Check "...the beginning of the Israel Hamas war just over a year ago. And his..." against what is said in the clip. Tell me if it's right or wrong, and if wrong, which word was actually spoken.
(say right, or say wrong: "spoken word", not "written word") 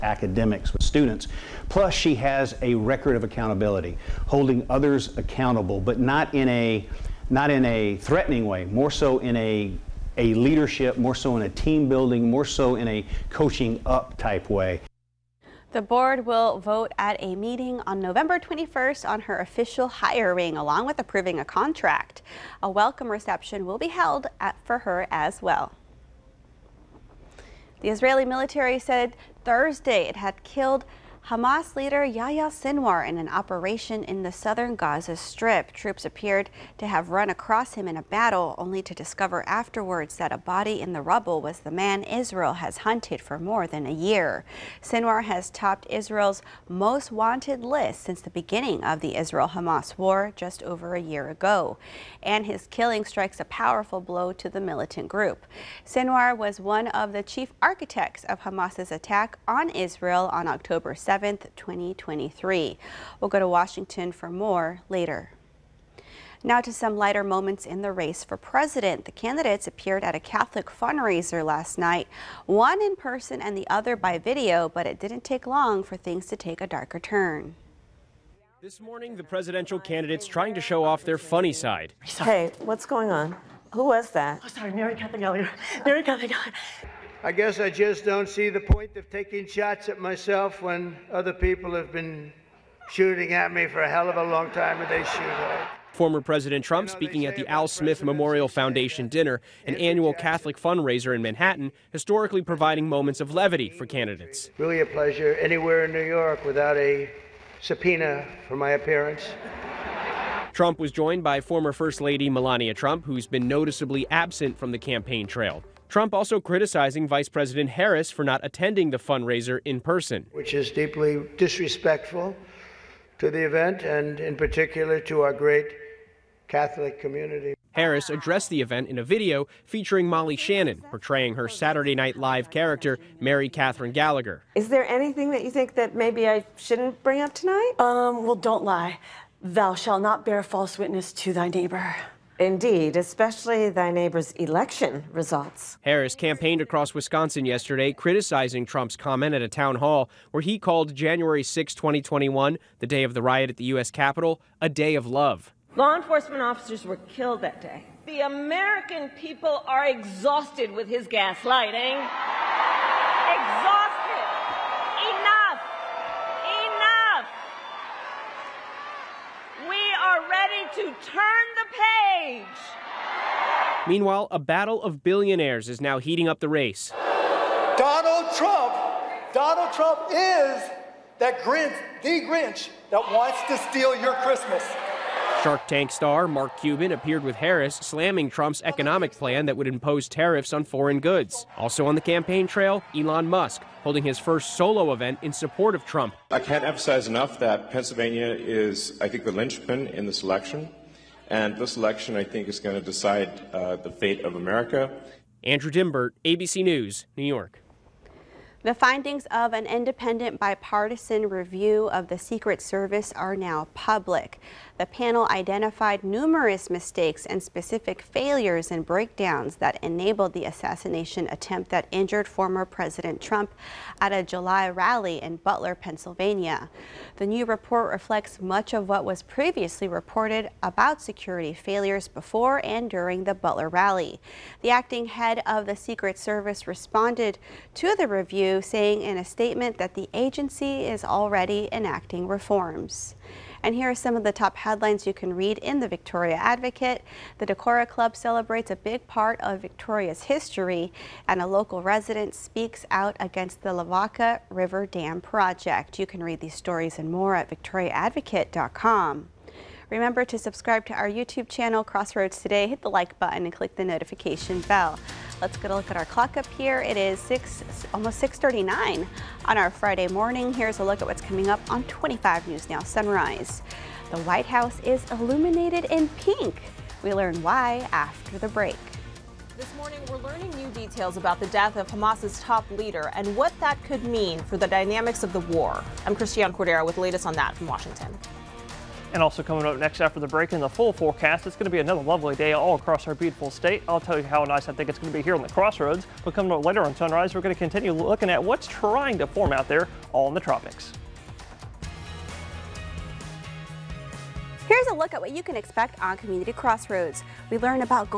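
right.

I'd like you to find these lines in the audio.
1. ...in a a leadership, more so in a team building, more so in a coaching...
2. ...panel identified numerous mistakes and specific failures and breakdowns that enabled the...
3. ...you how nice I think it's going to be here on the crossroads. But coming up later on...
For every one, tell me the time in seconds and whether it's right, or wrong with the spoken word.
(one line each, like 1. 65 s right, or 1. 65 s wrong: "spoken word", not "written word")
1. 9 s right
2. 214 s right
3. 294 s right.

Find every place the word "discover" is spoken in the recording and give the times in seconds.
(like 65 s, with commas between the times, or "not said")
38 s.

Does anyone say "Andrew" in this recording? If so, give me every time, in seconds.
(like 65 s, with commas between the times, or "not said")
205 s.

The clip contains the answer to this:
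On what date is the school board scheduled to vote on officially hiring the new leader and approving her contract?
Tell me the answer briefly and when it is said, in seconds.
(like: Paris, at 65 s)
November 21, at 18 s.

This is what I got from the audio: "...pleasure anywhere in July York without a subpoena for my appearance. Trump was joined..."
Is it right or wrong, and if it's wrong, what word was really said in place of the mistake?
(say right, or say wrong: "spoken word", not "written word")
wrong: "New", not "July".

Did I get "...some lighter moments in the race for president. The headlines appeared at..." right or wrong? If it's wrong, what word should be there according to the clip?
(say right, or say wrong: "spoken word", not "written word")
wrong: "candidates", not "headlines".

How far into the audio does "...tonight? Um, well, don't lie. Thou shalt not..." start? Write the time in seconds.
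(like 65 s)
137 s.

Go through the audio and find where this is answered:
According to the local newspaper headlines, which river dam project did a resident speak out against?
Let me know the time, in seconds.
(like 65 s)
253 s.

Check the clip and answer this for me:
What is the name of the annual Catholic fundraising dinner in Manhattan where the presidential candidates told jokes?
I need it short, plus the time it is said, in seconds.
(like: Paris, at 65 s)
Al Smith Memorial Foundation dinner, at 97 s.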